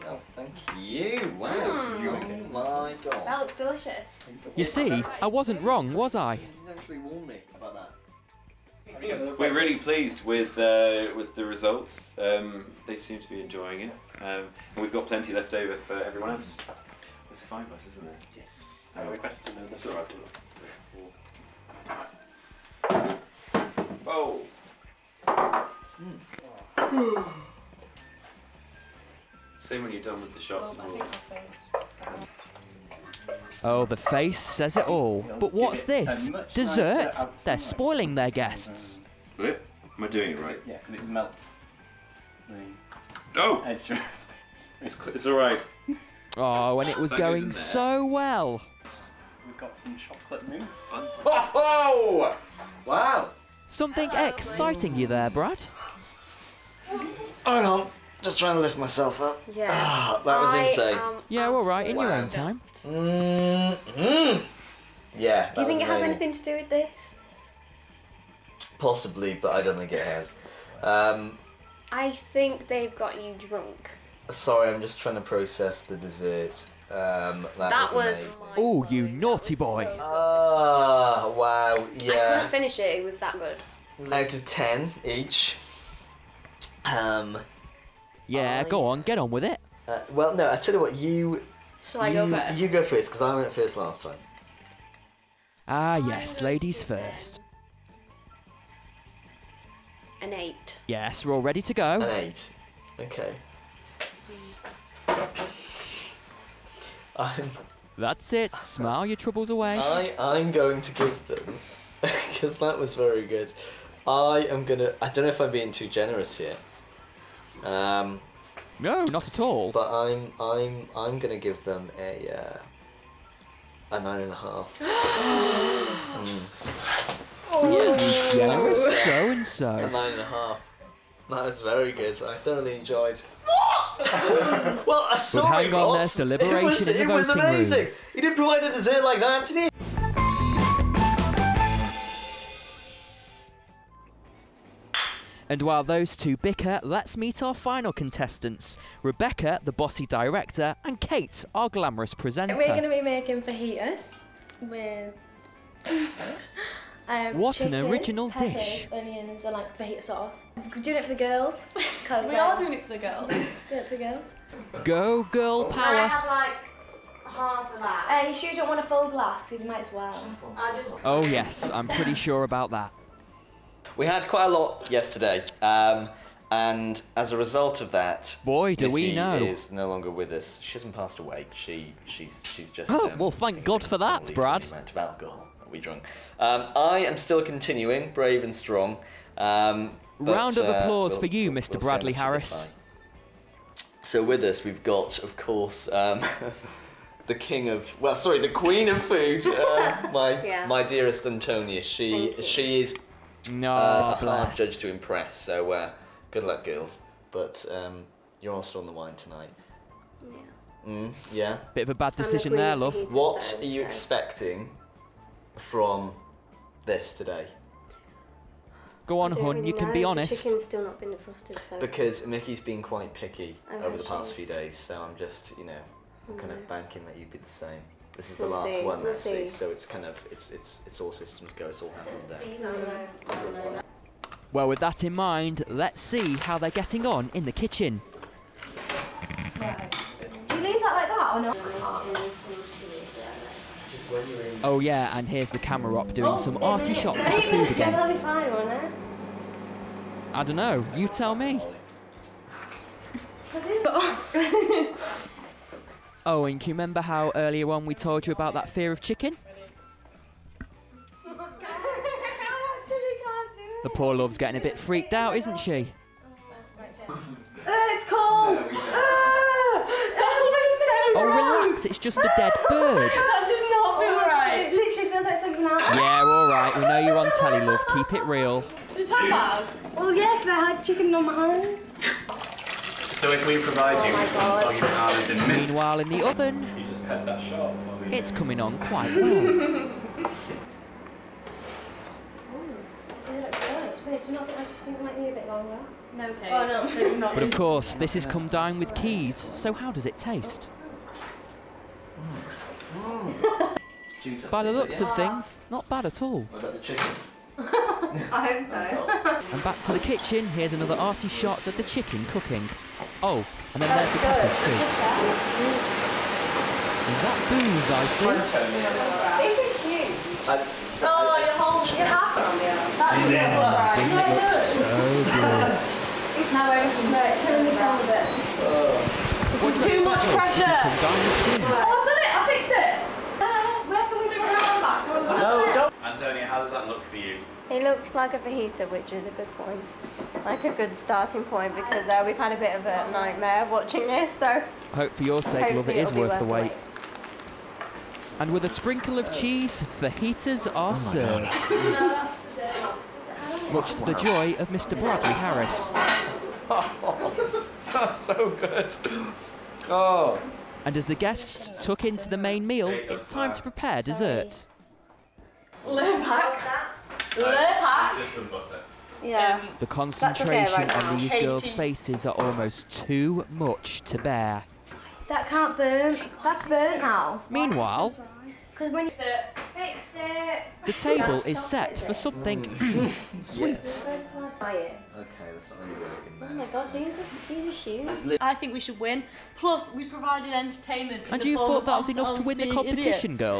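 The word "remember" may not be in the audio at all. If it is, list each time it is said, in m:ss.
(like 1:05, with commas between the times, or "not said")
4:16.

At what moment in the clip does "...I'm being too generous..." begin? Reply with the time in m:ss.
1:55.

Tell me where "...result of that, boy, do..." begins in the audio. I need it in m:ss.
2:57.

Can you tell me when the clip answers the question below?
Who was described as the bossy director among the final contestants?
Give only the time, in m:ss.
2:29.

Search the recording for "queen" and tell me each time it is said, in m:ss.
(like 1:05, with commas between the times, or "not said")
3:18.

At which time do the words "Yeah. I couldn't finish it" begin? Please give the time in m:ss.
1:22.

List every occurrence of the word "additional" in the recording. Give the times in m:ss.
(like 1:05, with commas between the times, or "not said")
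not said.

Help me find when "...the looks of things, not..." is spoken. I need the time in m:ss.
5:04.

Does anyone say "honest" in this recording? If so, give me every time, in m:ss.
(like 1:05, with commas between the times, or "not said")
3:40.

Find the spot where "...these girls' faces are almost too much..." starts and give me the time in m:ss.
6:11.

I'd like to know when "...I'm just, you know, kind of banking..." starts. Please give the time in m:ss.
3:45.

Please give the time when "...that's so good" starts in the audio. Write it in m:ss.
5:57.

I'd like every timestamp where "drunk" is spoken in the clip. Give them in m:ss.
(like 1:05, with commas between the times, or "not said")
1:13, 3:05.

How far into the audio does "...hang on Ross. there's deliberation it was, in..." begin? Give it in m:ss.
2:15.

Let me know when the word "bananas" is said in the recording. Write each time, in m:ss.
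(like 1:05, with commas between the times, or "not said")
4:44.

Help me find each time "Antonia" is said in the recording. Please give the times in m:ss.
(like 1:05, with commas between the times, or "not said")
3:21, 5:36.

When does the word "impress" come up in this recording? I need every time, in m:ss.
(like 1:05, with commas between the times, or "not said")
3:24.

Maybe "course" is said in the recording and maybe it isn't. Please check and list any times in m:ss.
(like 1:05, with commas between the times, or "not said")
3:15, 4:57.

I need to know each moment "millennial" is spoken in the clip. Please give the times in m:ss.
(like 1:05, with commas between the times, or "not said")
not said.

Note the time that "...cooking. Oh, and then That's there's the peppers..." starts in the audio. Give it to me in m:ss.
5:12.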